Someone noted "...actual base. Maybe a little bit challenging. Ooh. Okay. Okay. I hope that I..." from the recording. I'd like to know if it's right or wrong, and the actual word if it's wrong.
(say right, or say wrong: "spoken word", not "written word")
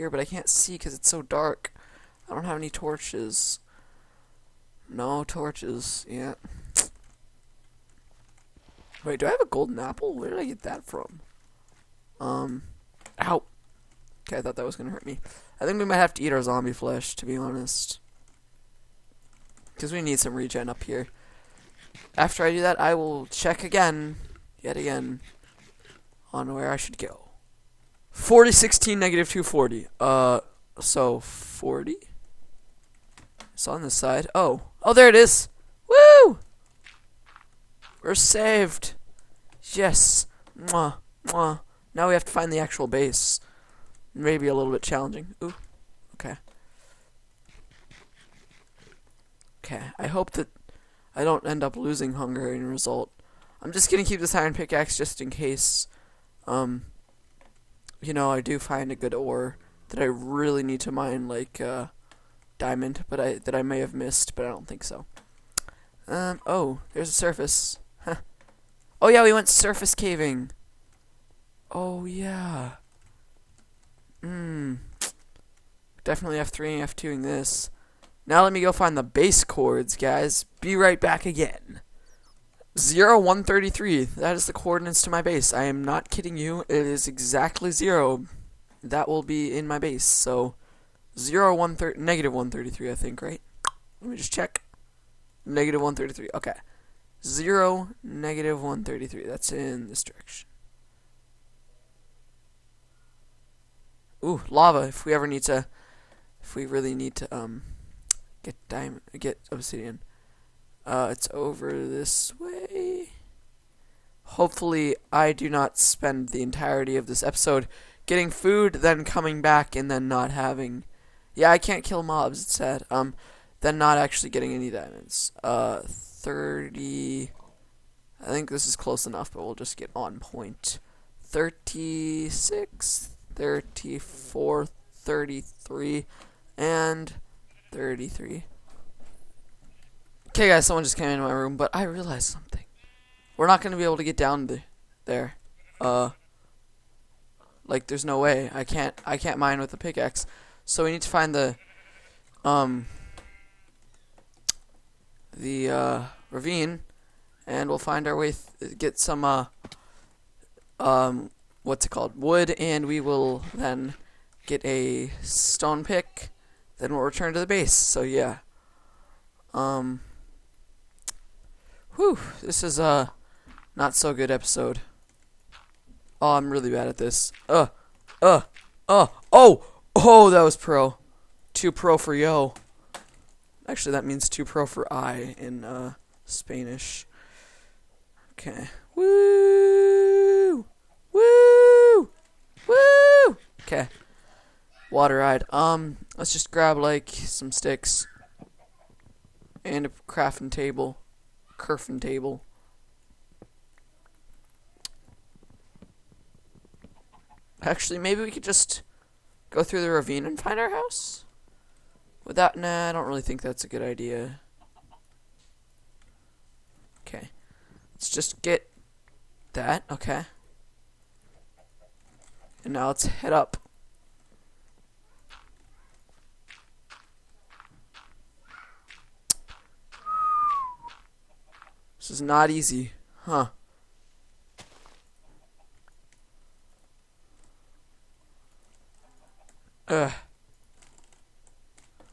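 right.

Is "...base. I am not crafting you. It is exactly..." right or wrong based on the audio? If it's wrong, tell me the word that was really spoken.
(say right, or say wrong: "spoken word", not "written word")
wrong: "kidding", not "crafting".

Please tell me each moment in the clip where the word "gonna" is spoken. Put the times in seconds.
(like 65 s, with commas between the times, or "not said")
14 s, 53 s.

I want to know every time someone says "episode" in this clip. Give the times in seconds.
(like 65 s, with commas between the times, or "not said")
117 s, 174 s.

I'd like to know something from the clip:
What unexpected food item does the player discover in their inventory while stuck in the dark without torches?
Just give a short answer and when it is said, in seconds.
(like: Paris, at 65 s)
golden apple, at 9 s.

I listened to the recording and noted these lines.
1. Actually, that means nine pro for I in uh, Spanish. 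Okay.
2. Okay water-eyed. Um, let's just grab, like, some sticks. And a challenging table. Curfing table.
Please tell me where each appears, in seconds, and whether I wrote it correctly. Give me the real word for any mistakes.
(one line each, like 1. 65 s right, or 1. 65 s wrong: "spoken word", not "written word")
1. 183 s wrong: "two", not "nine"
2. 193 s wrong: "crafting", not "challenging".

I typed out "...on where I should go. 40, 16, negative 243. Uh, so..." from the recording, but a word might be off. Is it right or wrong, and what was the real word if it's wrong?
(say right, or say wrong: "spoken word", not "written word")
wrong: "240", not "243".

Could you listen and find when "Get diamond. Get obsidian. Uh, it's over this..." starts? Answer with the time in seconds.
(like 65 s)
108 s.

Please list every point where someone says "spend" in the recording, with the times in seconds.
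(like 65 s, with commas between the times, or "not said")
115 s.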